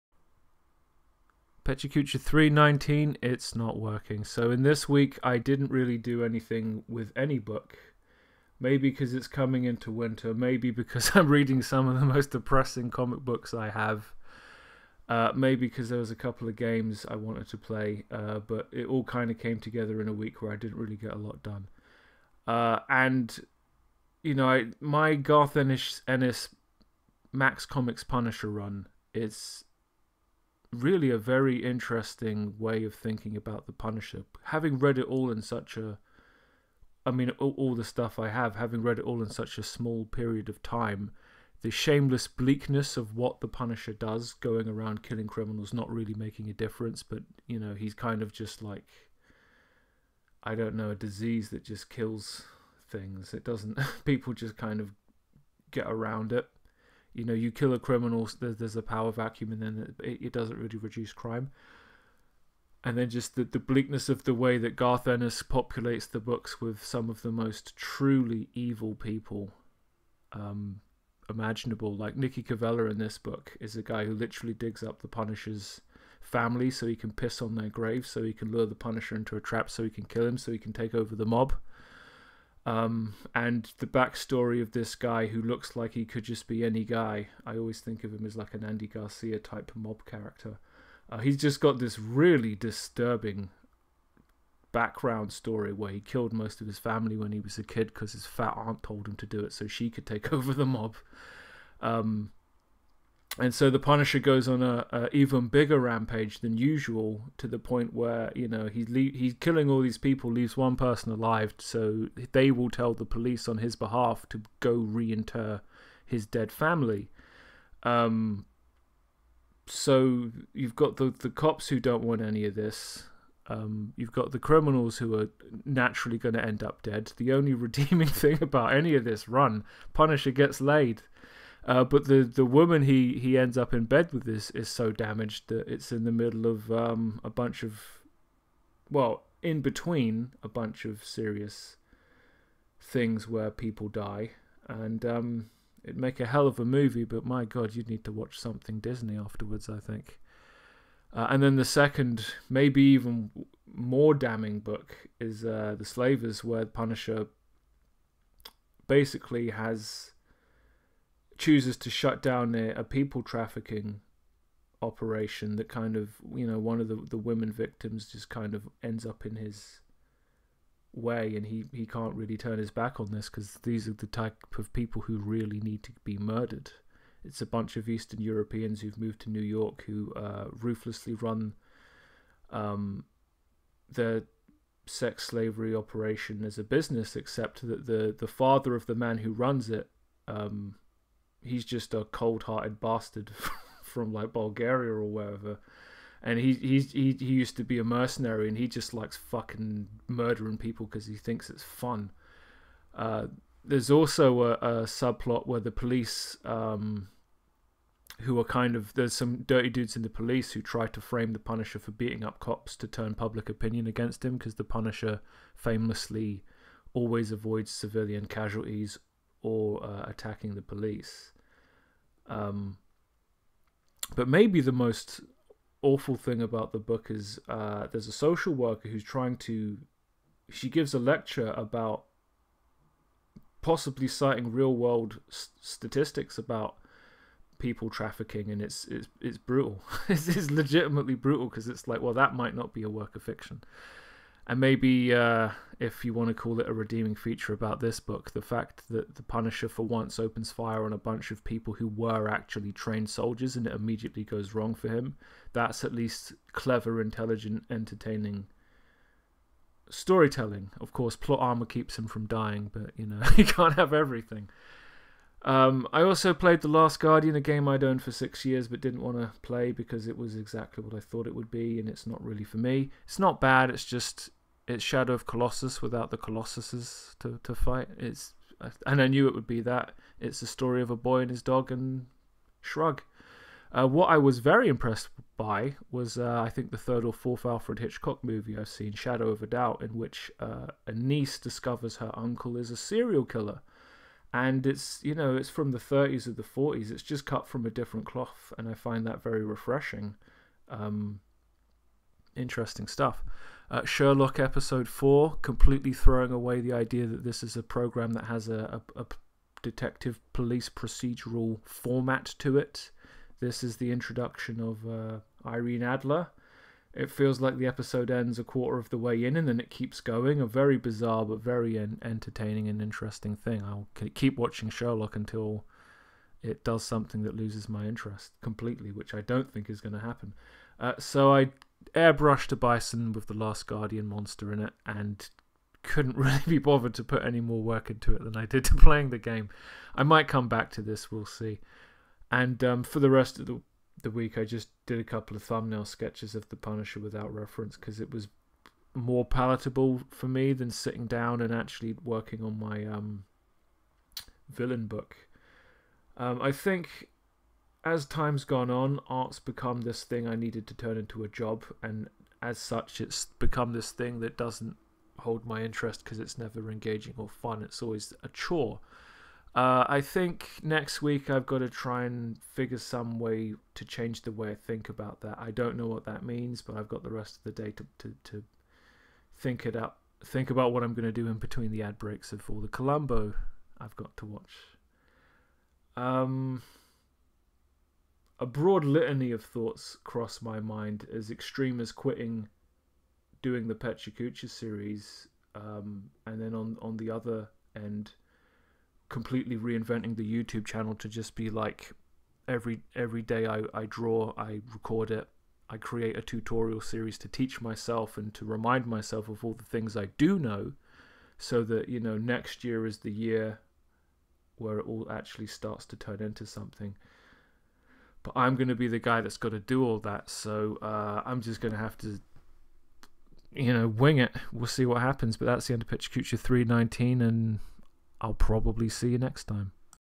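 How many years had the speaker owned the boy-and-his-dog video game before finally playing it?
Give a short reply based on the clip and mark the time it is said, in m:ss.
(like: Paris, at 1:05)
6, at 4:28.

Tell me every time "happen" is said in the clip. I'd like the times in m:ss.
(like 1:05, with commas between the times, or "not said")
5:29, 7:05.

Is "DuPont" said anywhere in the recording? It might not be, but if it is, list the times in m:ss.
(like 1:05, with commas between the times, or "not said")
not said.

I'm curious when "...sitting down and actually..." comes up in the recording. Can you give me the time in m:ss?
5:50.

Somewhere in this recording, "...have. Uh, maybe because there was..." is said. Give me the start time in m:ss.
0:13.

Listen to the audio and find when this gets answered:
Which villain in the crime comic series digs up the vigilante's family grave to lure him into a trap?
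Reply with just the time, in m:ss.
1:12.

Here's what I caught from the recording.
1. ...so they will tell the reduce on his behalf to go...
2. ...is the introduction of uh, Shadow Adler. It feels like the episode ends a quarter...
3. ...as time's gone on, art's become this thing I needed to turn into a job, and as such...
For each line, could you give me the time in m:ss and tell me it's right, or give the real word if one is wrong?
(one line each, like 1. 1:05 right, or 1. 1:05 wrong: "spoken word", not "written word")
1. 1:51 wrong: "police", not "reduce"
2. 5:13 wrong: "Irene", not "Shadow"
3. 5:57 right.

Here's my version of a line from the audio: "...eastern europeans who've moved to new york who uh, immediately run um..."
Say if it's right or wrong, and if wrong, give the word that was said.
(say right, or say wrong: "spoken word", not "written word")
wrong: "ruthlessly", not "immediately".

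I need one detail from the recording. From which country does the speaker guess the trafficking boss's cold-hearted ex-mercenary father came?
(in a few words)
Bulgaria.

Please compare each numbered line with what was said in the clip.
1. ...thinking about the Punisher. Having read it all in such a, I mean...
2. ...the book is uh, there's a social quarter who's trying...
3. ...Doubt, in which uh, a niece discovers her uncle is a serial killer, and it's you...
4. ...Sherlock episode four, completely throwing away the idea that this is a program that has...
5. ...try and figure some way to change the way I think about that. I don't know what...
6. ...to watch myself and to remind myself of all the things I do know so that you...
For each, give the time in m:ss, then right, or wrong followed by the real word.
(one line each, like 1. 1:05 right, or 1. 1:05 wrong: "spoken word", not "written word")
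1. 0:32 right
2. 3:46 wrong: "worker", not "quarter"
3. 4:49 right
4. 5:03 right
5. 6:11 right
6. 6:47 wrong: "teach", not "watch".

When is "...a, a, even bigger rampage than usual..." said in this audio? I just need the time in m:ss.
1:44.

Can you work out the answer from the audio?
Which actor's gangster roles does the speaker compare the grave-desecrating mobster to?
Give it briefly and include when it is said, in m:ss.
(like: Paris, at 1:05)
Andy Garcia, at 1:28.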